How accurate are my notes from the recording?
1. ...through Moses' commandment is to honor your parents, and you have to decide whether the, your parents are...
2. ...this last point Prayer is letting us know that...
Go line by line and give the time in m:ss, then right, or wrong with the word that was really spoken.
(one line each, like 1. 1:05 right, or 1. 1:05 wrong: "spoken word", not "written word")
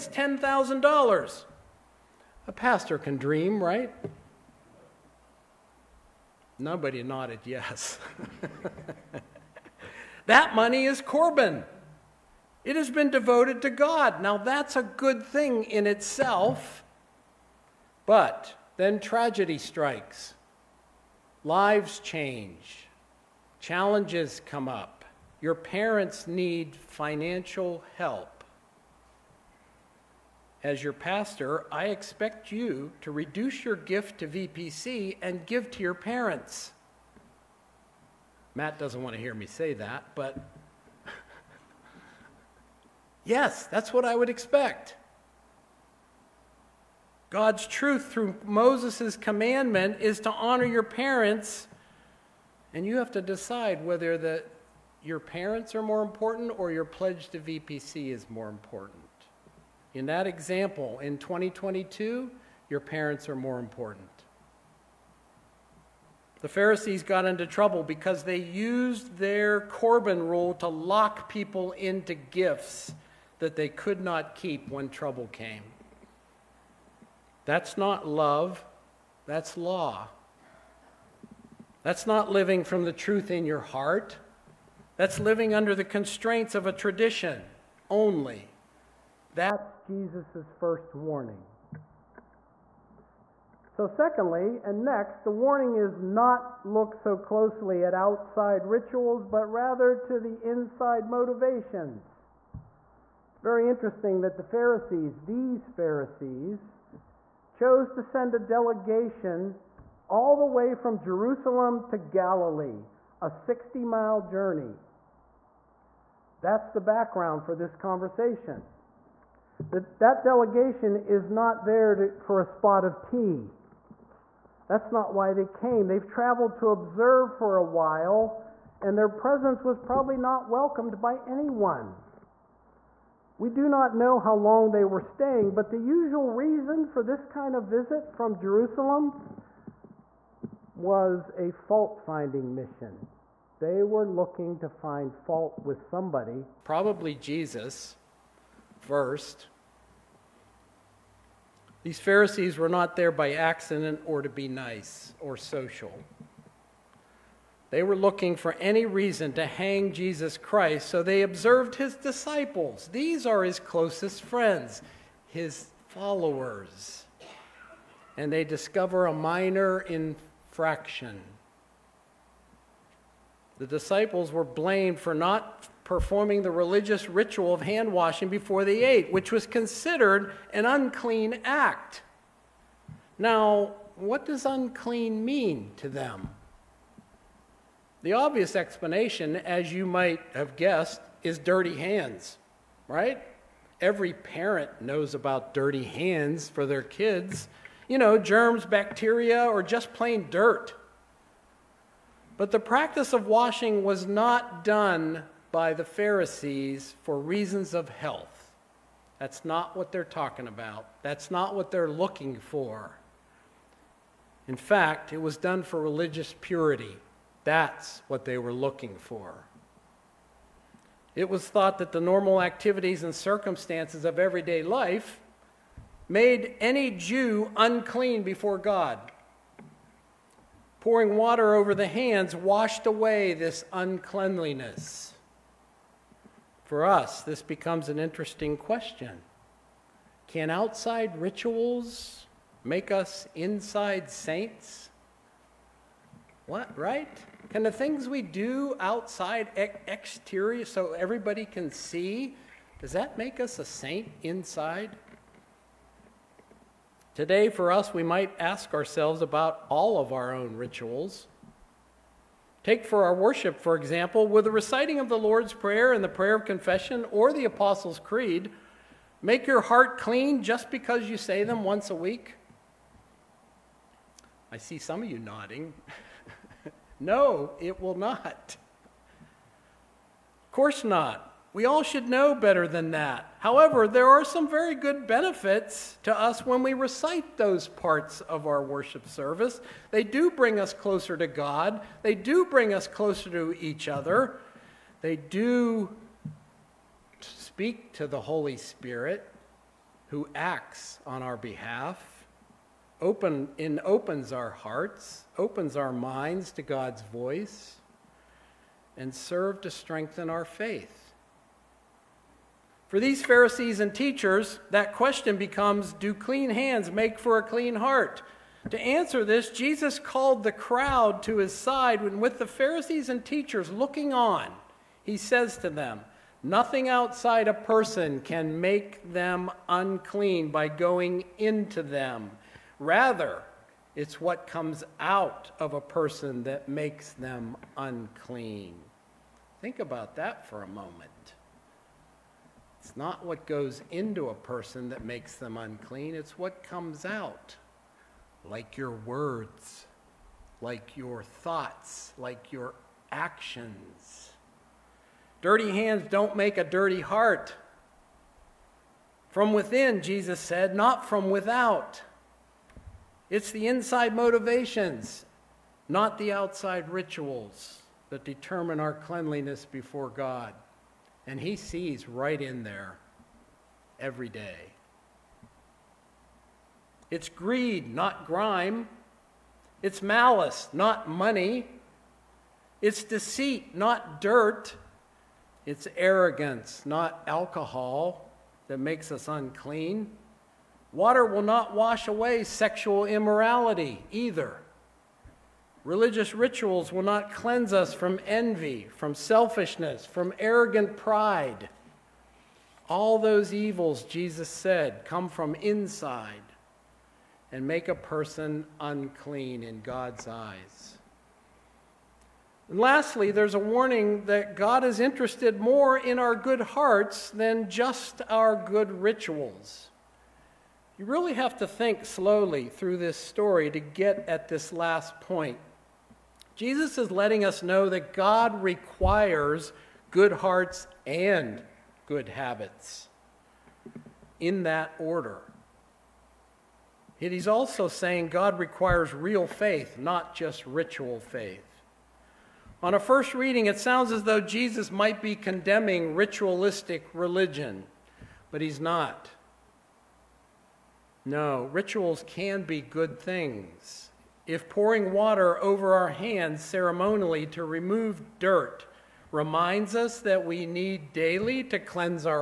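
1. 0:48 right
2. 7:04 wrong: "Jesus", not "Prayer".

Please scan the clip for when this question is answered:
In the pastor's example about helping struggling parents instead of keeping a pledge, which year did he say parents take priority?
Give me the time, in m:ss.
1:01.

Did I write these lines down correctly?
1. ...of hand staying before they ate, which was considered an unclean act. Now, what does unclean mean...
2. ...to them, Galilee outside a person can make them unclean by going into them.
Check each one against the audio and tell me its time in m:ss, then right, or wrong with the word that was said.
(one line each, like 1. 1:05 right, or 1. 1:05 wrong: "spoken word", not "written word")
1. 2:57 wrong: "washing", not "staying"
2. 5:25 wrong: "Nothing", not "Galilee".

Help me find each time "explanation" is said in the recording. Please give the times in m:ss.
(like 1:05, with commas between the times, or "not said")
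3:08.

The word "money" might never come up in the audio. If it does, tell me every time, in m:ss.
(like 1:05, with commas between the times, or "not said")
0:10, 6:21.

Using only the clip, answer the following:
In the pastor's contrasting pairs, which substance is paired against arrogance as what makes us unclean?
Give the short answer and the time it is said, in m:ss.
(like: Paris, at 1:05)
alcohol, at 6:27.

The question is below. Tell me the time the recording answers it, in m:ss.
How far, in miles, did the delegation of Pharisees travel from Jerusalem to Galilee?
1:53.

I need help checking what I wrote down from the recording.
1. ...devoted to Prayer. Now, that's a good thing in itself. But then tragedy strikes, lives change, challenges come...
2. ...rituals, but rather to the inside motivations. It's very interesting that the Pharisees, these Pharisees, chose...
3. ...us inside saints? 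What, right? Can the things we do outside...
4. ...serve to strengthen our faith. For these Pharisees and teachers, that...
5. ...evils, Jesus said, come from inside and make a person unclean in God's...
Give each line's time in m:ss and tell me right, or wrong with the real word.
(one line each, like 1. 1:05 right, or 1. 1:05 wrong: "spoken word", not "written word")
1. 0:13 wrong: "God", not "Prayer"
2. 1:38 right
3. 4:02 right
4. 5:09 right
5. 6:43 right.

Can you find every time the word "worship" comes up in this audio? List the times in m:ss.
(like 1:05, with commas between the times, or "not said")
4:23, 4:48.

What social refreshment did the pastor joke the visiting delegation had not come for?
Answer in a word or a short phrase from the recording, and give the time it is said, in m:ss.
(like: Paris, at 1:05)
a spot of tea, at 2:02.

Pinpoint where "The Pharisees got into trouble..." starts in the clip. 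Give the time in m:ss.
1:06.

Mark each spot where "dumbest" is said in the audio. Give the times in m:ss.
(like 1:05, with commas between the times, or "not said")
not said.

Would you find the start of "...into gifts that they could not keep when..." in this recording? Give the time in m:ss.
1:11.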